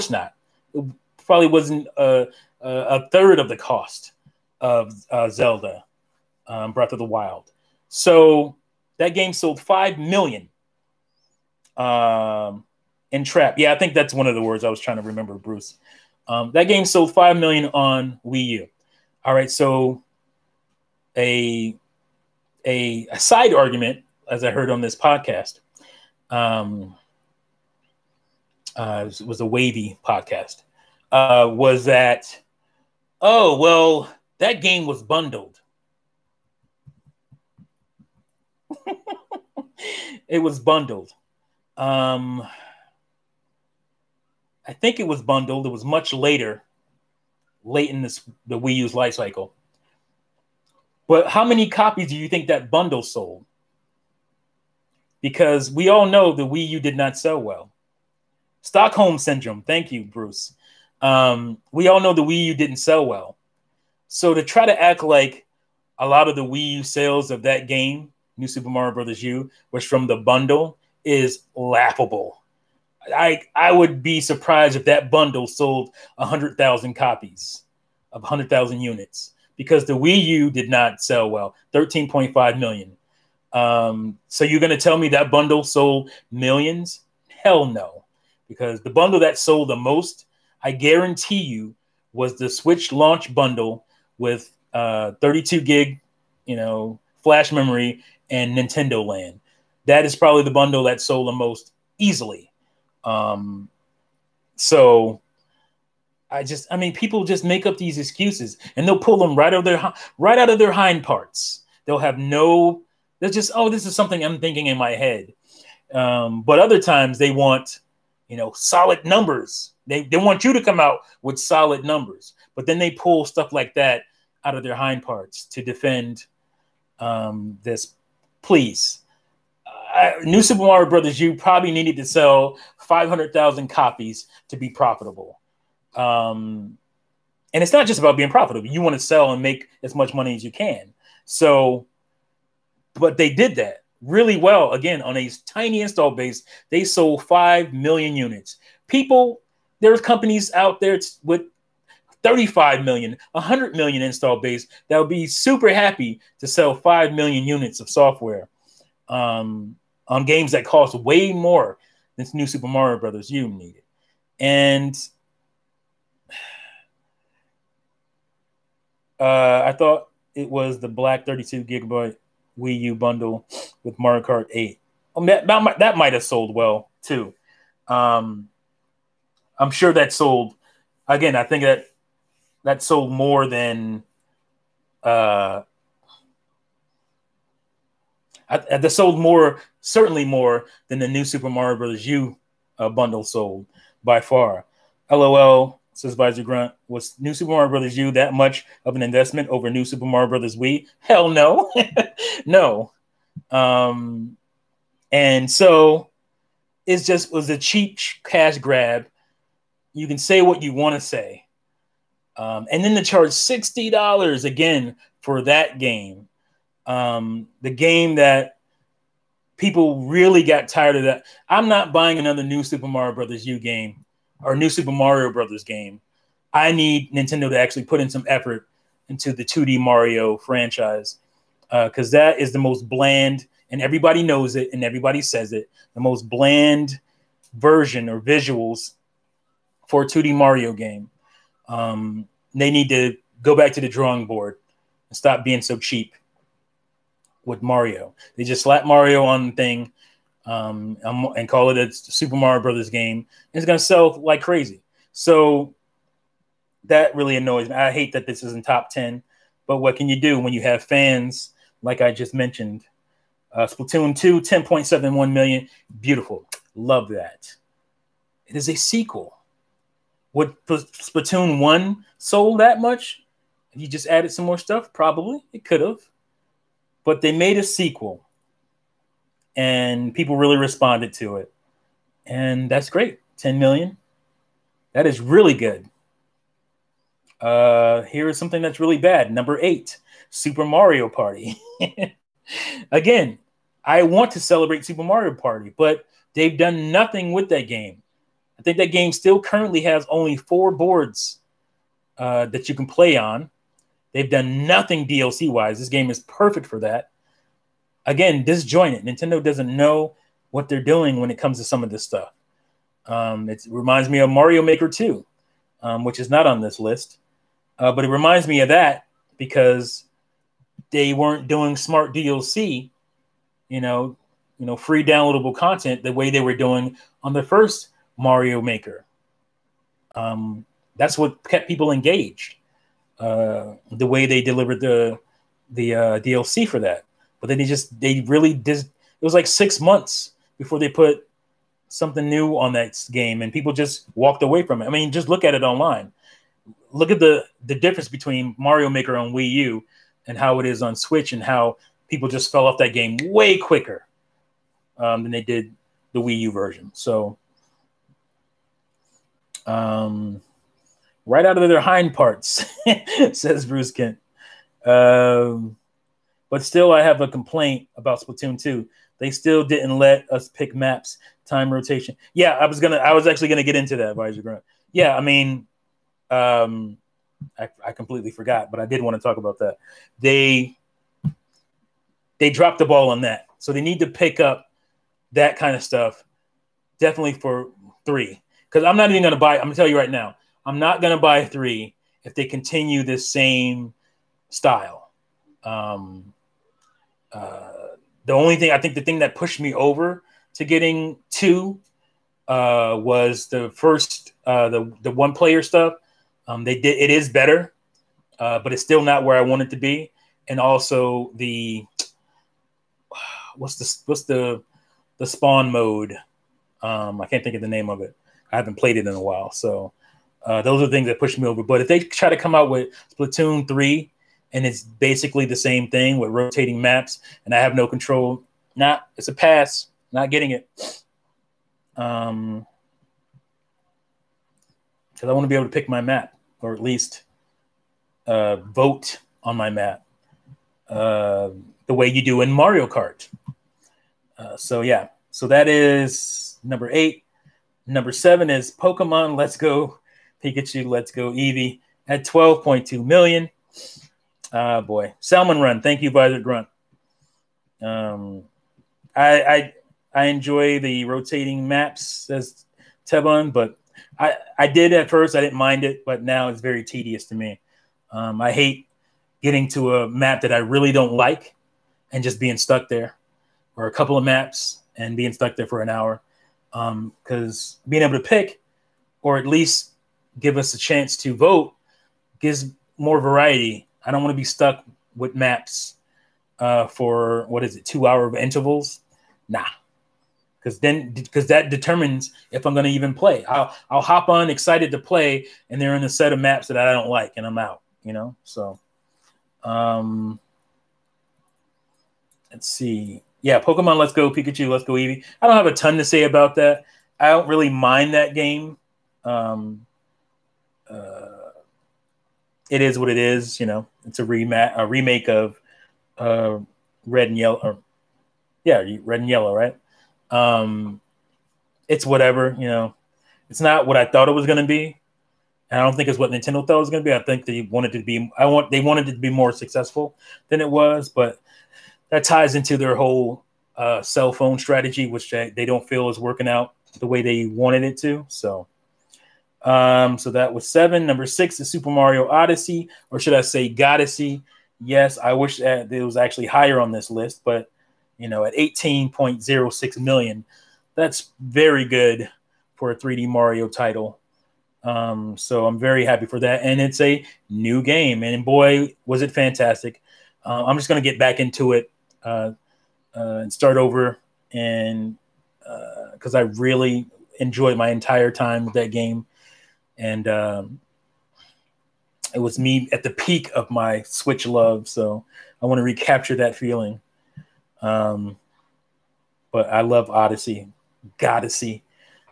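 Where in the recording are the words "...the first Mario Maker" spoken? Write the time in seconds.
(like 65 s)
327 s.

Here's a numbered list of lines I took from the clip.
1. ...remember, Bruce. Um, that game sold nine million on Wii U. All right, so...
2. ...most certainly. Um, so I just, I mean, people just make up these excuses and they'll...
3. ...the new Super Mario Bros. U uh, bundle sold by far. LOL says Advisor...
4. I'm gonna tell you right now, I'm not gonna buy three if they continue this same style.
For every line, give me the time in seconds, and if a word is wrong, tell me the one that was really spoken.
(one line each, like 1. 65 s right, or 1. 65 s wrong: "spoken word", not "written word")
1. 15 s wrong: "five", not "nine"
2. 101 s wrong: "easily", not "certainly"
3. 190 s right
4. 389 s right.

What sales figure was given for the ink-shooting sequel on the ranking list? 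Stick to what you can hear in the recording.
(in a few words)
10.71 million.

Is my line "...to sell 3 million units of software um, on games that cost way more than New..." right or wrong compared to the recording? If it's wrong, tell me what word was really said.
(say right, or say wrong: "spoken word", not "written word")
wrong: "5", not "3".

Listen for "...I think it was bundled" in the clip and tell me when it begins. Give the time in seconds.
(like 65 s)
44 s.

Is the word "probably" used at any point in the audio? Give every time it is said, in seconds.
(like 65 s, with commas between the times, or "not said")
1 s, 100 s, 131 s, 274 s.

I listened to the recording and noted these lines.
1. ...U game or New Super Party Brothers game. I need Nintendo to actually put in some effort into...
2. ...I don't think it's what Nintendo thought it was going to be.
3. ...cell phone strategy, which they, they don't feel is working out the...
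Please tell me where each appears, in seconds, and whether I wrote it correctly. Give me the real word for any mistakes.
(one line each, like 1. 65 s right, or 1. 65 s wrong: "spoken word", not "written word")
1. 223 s wrong: "Mario", not "Party"
2. 525 s right
3. 534 s right.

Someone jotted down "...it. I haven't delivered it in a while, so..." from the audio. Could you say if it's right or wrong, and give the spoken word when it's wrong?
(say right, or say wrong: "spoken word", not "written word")
wrong: "played", not "delivered".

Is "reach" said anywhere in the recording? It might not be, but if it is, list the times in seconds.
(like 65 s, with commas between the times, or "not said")
not said.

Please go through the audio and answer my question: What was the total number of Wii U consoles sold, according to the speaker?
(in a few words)
13.5 million.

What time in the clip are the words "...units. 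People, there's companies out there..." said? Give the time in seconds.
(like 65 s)
148 s.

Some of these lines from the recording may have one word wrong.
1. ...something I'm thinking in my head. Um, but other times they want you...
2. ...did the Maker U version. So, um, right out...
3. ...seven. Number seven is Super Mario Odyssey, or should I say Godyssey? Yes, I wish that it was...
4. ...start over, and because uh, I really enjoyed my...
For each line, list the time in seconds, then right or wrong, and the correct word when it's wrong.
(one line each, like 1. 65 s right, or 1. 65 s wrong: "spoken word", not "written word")
1. 113 s right
2. 355 s wrong: "Wii", not "Maker"
3. 540 s wrong: "six", not "seven"
4. 563 s right.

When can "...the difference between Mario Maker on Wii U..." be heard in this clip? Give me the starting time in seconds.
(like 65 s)
347 s.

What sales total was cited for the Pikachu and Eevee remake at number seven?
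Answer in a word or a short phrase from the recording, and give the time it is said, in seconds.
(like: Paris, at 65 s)
12.2 million, at 452 s.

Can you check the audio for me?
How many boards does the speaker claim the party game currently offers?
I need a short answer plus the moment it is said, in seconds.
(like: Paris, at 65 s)
4, at 300 s.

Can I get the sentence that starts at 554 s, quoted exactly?
Um, so I'm very happy for that, and it's a new game, and boy, was it fantastic!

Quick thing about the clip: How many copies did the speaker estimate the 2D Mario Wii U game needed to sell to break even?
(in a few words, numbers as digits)
500,000.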